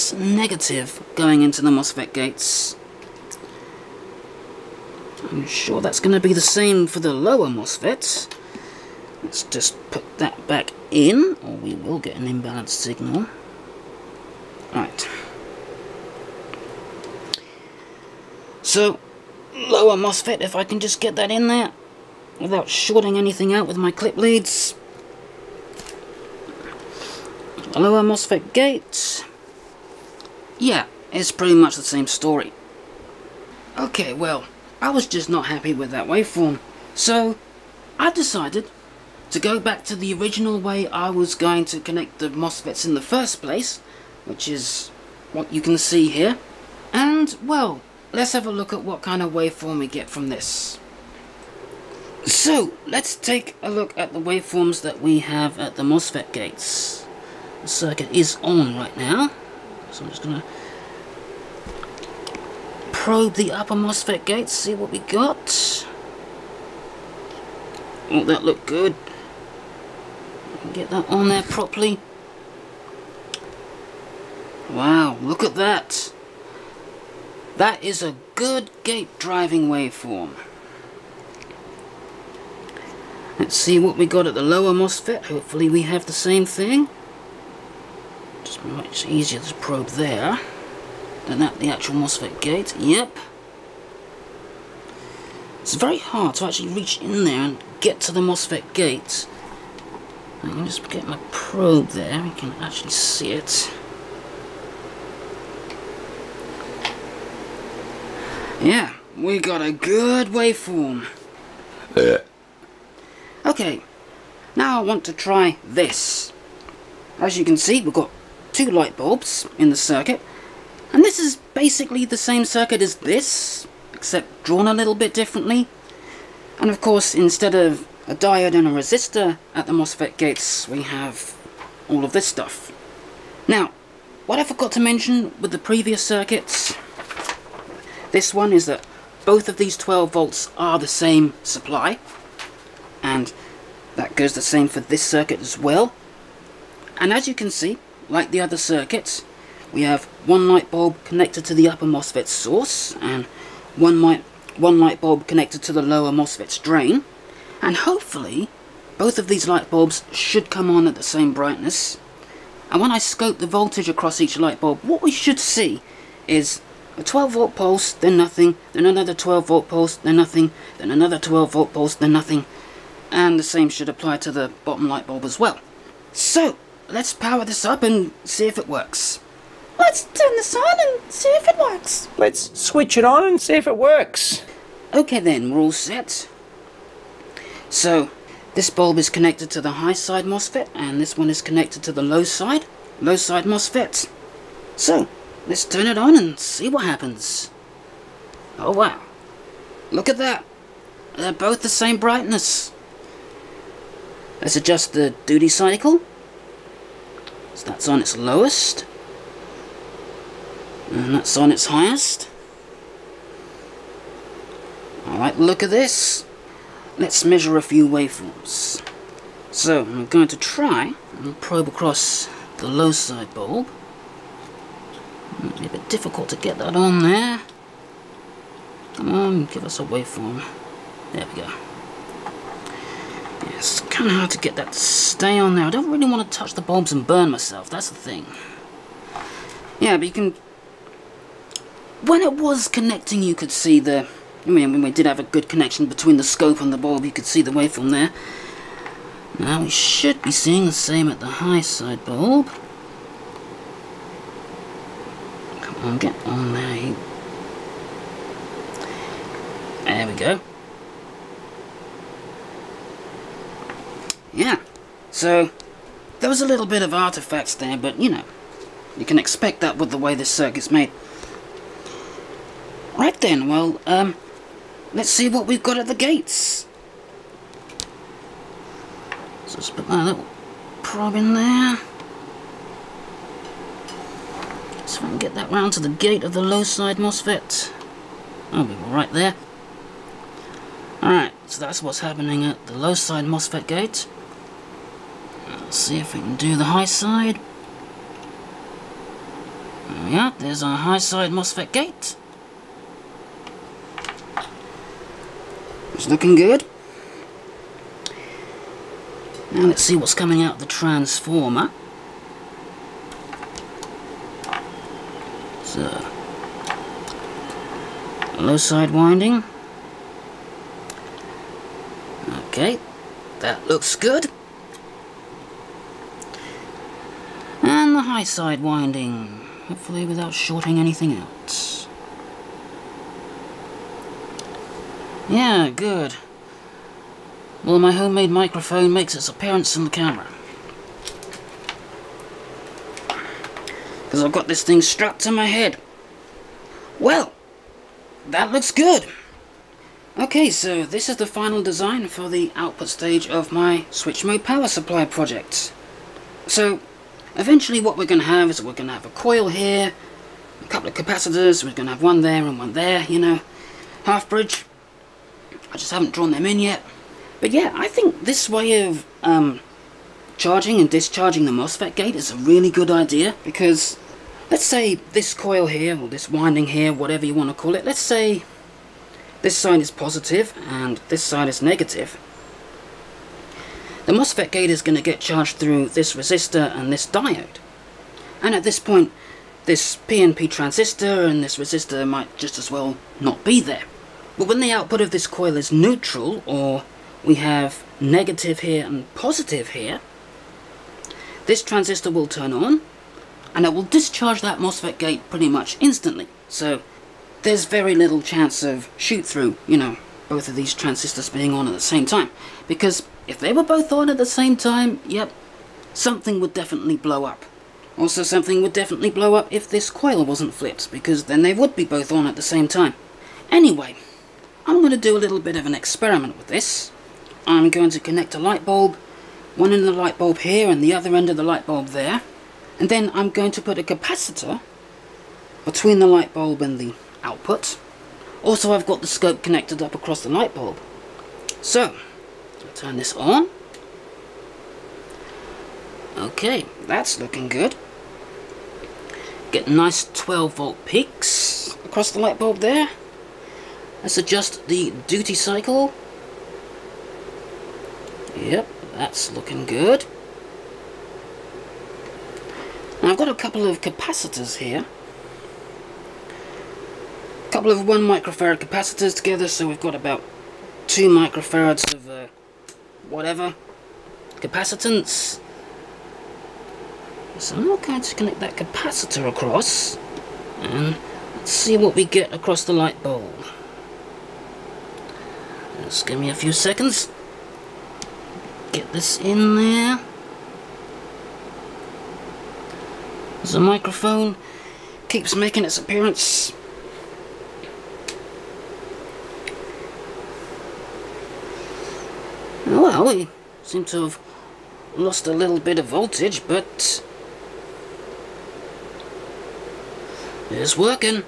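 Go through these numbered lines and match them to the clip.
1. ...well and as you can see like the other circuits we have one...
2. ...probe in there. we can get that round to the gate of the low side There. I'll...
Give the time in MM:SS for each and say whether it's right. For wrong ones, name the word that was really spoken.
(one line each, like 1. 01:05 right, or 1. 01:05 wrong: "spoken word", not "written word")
1. 02:25 right
2. 04:40 wrong: "MOSFET", not "There".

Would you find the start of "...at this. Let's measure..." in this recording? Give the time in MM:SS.
03:35.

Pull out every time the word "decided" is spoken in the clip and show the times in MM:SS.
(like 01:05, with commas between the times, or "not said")
00:38.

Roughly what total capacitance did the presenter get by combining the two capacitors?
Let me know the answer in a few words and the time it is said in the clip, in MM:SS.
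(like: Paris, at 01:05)
2 microfarads, at 07:50.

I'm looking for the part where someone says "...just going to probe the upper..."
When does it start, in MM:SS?
01:00.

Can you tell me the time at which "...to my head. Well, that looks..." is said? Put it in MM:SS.
05:45.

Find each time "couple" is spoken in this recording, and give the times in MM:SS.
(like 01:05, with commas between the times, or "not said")
06:00, 07:43, 07:47.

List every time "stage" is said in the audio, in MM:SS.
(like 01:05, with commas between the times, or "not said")
05:52.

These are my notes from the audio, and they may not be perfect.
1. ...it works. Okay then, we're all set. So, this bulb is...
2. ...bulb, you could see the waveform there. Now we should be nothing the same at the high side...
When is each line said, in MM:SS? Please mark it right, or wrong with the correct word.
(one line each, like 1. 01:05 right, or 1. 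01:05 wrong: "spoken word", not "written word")
1. 03:03 right
2. 04:06 wrong: "seeing", not "nothing".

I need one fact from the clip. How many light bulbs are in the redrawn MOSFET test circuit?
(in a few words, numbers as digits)
2.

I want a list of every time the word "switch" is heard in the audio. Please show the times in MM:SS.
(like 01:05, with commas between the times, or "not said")
03:02, 05:53.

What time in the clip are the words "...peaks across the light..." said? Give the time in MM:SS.
07:30.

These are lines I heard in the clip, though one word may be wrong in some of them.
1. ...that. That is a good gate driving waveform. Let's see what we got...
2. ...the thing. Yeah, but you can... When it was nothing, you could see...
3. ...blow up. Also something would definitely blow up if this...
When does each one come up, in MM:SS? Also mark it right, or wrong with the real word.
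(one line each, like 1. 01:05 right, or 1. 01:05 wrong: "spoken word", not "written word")
1. 01:15 right
2. 03:57 wrong: "connecting", not "nothing"
3. 06:56 right.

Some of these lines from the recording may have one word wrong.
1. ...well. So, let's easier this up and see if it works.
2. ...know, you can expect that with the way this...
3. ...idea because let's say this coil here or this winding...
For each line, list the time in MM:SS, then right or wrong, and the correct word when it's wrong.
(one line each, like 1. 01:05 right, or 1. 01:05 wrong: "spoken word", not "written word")
1. 02:55 wrong: "power", not "easier"
2. 04:28 right
3. 06:12 right.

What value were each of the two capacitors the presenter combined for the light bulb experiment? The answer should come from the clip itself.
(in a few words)
1 microfarad.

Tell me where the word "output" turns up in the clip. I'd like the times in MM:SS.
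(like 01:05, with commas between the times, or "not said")
05:52, 06:34, 07:17.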